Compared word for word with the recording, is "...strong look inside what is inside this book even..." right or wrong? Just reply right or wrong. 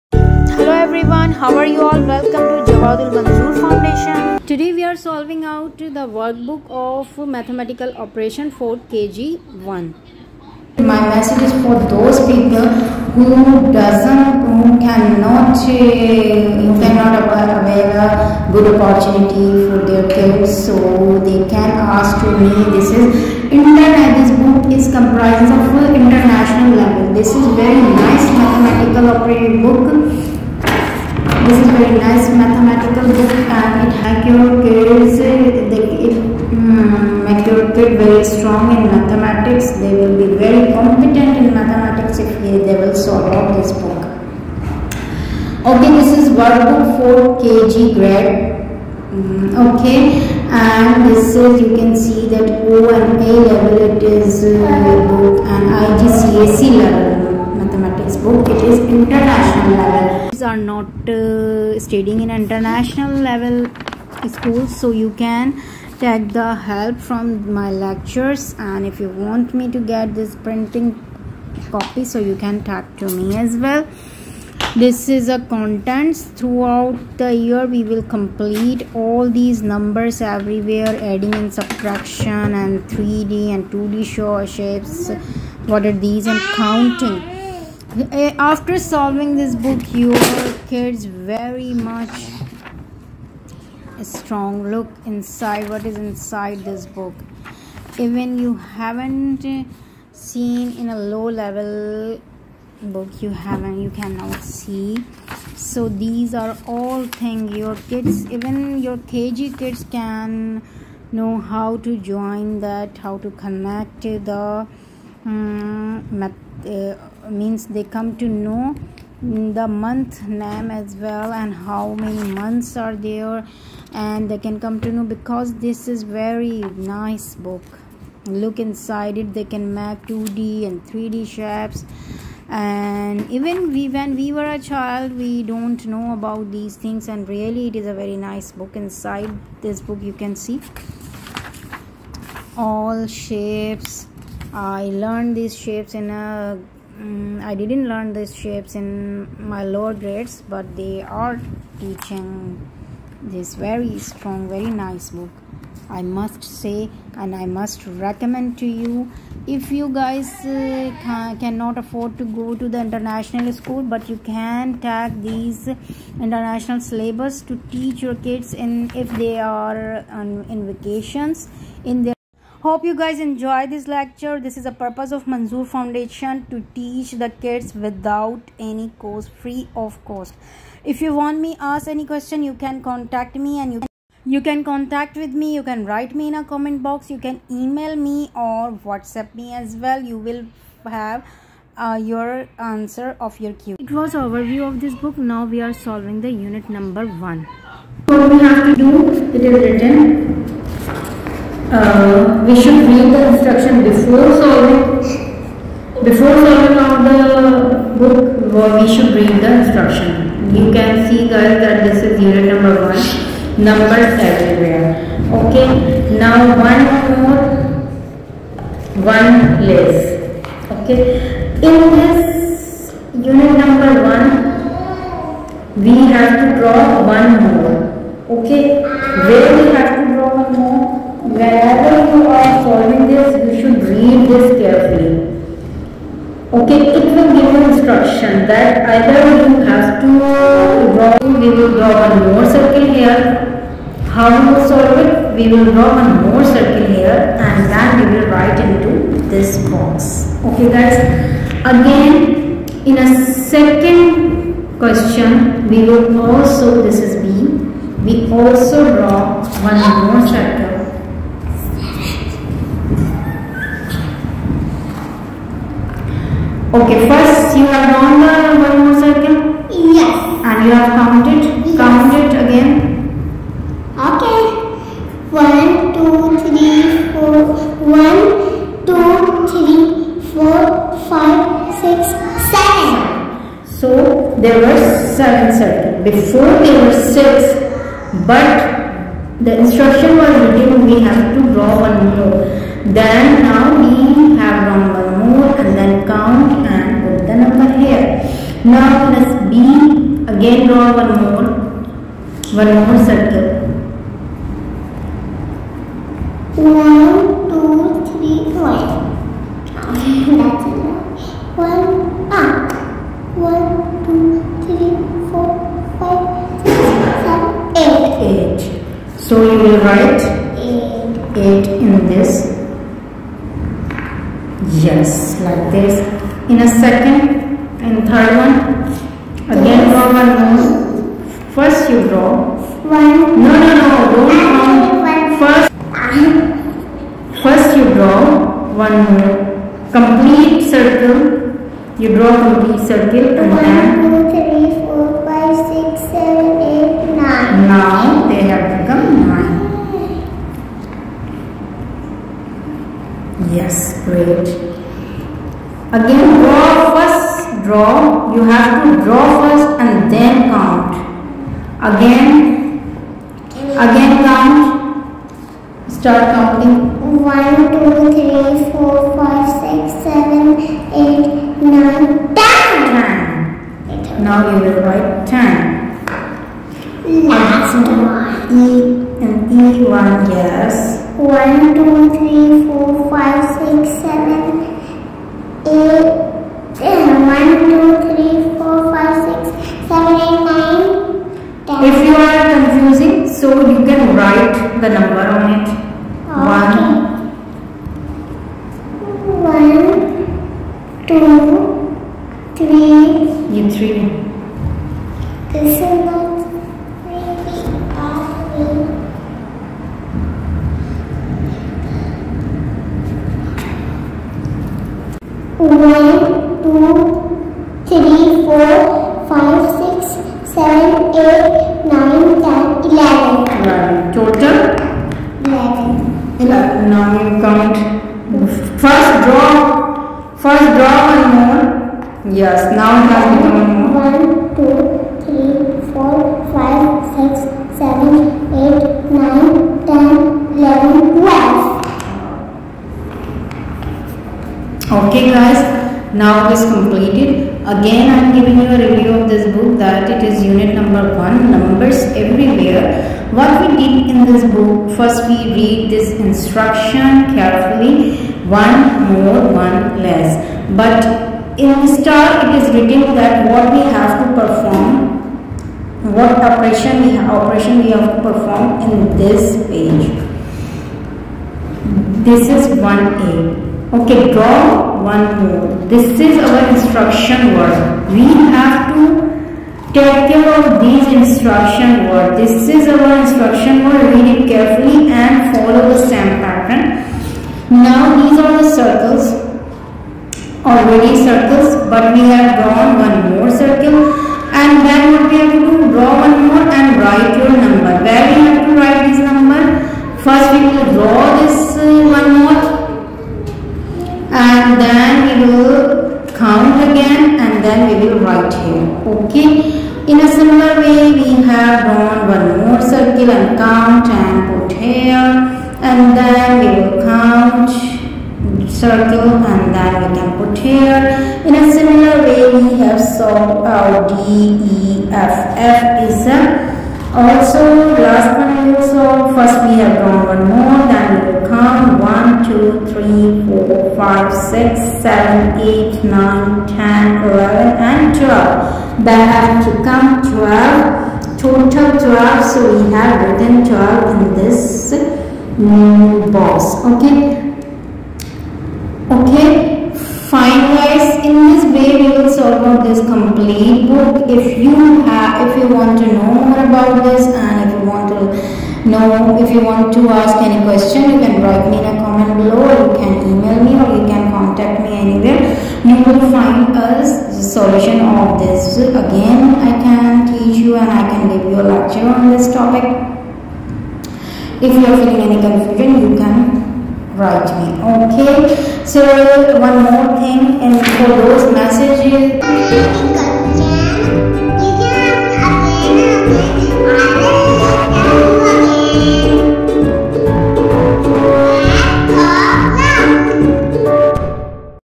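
right.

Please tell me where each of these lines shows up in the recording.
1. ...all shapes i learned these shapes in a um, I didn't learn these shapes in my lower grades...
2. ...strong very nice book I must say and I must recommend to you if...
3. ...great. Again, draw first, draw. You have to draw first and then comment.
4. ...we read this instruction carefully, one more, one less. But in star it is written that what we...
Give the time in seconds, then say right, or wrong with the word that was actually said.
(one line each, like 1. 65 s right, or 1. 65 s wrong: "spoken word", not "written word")
1. 142 s right
2. 153 s right
3. 354 s wrong: "count", not "comment"
4. 455 s right.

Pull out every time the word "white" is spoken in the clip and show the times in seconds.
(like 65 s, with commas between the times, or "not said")
508 s.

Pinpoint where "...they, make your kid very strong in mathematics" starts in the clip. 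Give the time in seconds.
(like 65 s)
37 s.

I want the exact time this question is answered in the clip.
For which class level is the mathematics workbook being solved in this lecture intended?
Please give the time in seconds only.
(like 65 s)
8 s.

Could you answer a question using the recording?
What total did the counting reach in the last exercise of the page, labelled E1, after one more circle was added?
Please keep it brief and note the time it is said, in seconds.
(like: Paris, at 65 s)
12, at 441 s.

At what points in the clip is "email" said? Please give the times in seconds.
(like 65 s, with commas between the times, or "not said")
187 s, 563 s.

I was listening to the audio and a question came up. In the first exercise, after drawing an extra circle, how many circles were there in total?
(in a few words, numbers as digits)
7.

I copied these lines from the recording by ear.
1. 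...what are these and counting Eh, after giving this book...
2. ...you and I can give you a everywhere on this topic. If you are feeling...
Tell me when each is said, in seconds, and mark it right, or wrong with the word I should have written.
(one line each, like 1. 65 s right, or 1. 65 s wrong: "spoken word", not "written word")
1. 85 s wrong: "solving", not "giving"
2. 570 s wrong: "lecture", not "everywhere".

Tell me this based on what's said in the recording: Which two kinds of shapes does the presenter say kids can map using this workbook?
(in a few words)
2D and 3D shapes.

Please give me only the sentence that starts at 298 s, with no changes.
Now let's B again draw one more, one more circle.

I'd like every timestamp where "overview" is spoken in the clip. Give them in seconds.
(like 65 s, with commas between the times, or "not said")
194 s.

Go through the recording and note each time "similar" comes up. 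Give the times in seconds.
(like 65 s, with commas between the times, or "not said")
510 s, 521 s.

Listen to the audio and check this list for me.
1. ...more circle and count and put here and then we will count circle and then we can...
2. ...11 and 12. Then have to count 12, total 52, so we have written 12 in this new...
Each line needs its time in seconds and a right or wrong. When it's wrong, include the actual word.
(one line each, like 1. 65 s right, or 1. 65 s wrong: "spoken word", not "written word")
1. 512 s right
2. 537 s wrong: "12", not "52".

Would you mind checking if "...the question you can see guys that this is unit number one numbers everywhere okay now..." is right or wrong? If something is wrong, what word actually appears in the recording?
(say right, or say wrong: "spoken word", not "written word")
wrong: "instruction", not "question".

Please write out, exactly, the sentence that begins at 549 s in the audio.
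Okay, yes, in this way we will solve out this complete book.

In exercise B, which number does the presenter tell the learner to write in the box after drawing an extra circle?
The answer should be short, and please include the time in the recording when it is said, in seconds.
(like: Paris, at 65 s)
8, at 320 s.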